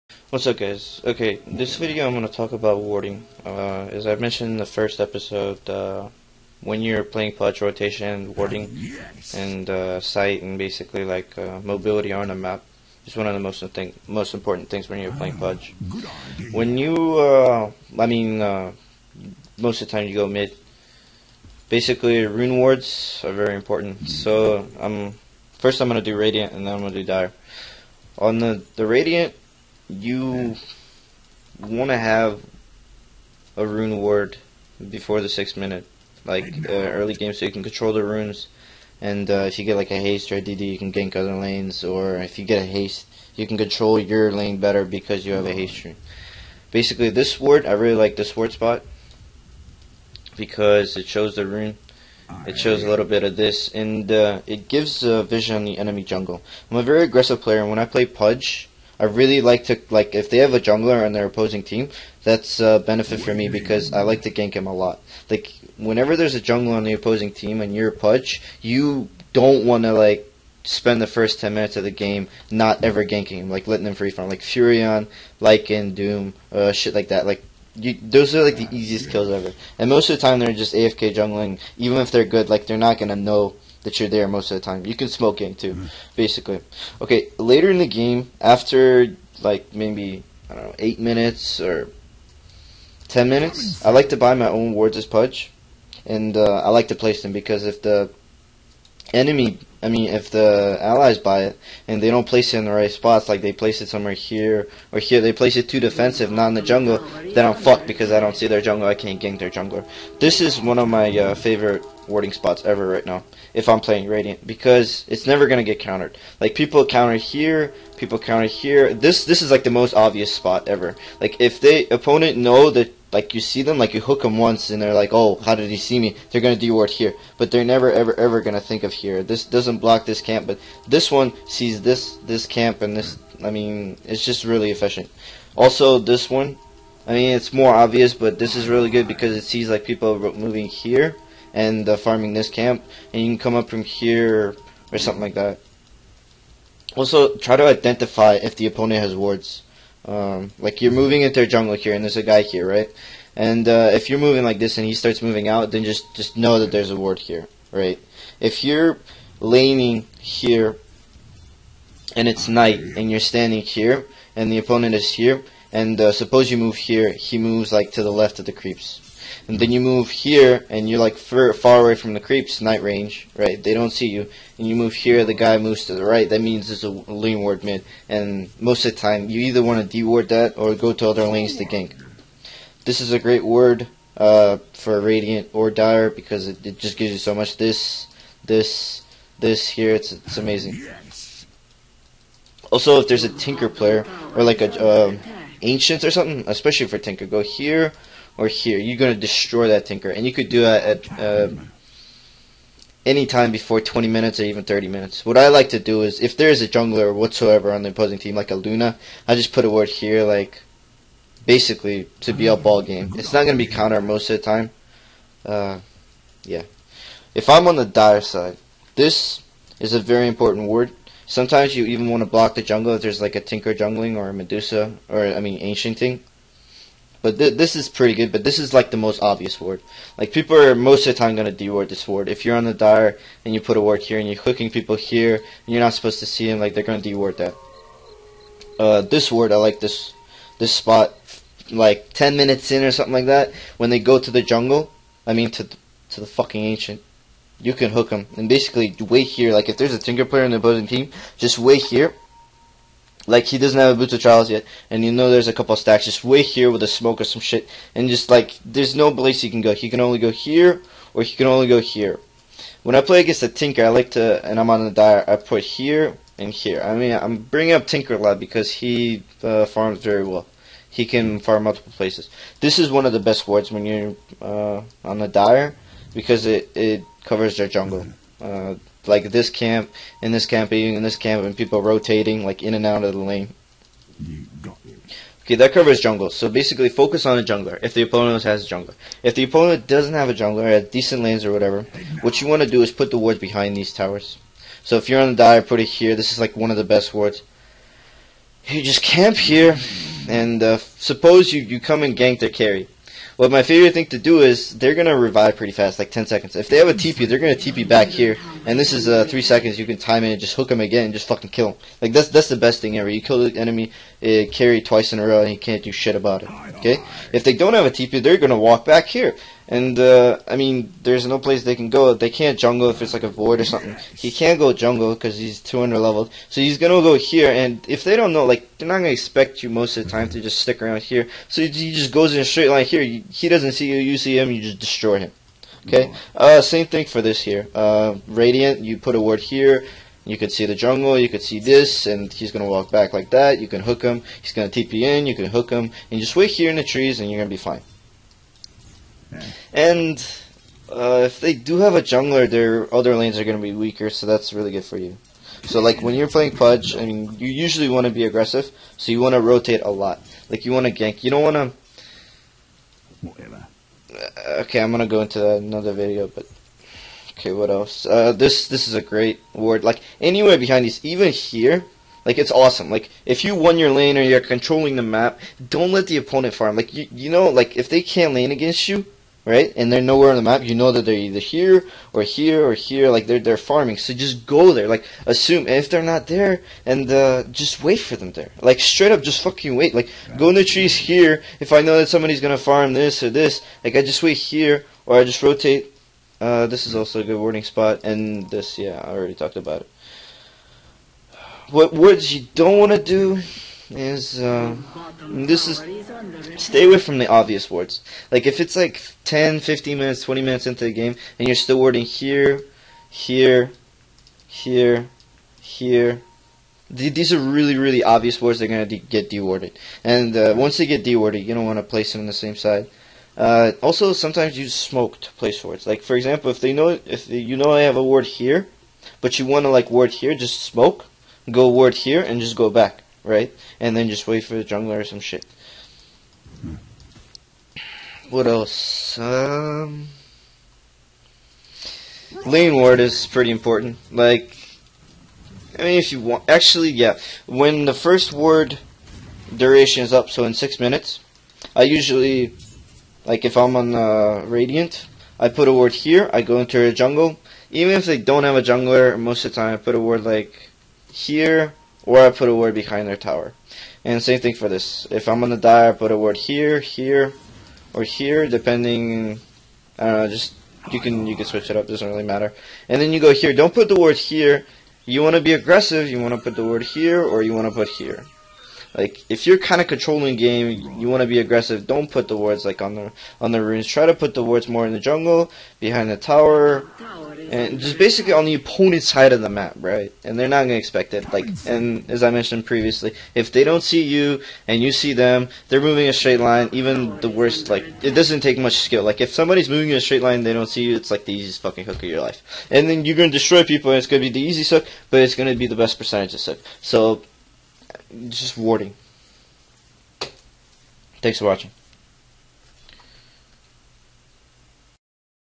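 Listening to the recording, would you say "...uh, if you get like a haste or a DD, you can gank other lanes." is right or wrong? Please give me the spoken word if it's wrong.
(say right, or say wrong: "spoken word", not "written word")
right.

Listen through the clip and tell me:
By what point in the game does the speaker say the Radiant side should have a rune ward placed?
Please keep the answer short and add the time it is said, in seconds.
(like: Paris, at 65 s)
Before the sixth minute, at 34 s.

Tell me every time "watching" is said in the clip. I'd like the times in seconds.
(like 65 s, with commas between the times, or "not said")
511 s.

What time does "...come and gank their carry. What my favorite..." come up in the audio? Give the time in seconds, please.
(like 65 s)
301 s.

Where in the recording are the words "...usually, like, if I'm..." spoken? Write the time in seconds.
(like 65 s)
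451 s.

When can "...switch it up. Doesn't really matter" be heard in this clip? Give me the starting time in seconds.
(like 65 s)
471 s.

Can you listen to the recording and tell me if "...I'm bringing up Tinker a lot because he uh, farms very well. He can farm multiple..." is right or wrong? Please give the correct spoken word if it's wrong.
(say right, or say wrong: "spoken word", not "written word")
right.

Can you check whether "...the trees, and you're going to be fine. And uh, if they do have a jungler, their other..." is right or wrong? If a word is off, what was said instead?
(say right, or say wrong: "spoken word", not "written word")
right.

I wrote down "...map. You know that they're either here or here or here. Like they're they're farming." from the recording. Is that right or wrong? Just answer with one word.
right.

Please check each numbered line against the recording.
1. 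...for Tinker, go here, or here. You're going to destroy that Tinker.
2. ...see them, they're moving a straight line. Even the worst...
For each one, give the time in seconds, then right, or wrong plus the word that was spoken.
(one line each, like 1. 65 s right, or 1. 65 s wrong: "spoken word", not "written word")
1. 196 s right
2. 494 s right.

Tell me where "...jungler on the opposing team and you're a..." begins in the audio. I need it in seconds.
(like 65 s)
66 s.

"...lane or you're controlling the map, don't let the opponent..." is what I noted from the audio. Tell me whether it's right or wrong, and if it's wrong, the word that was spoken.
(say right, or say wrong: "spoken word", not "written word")
right.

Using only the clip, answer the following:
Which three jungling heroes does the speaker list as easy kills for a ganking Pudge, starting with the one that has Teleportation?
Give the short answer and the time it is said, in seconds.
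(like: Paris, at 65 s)
Furion, Lycan, Doom, at 74 s.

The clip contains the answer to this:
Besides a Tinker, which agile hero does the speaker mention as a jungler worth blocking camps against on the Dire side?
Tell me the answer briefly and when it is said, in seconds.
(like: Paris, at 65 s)
Medusa, at 224 s.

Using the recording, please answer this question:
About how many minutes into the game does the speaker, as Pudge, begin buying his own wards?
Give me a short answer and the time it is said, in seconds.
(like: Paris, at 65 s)
8 minutes, at 90 s.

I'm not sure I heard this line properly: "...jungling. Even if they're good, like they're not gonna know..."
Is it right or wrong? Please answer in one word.
right.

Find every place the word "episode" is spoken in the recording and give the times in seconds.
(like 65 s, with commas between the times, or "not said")
5 s.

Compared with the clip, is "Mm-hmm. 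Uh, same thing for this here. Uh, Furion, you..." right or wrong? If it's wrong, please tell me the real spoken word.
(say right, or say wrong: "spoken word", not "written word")
wrong: "Radiant", not "Furion".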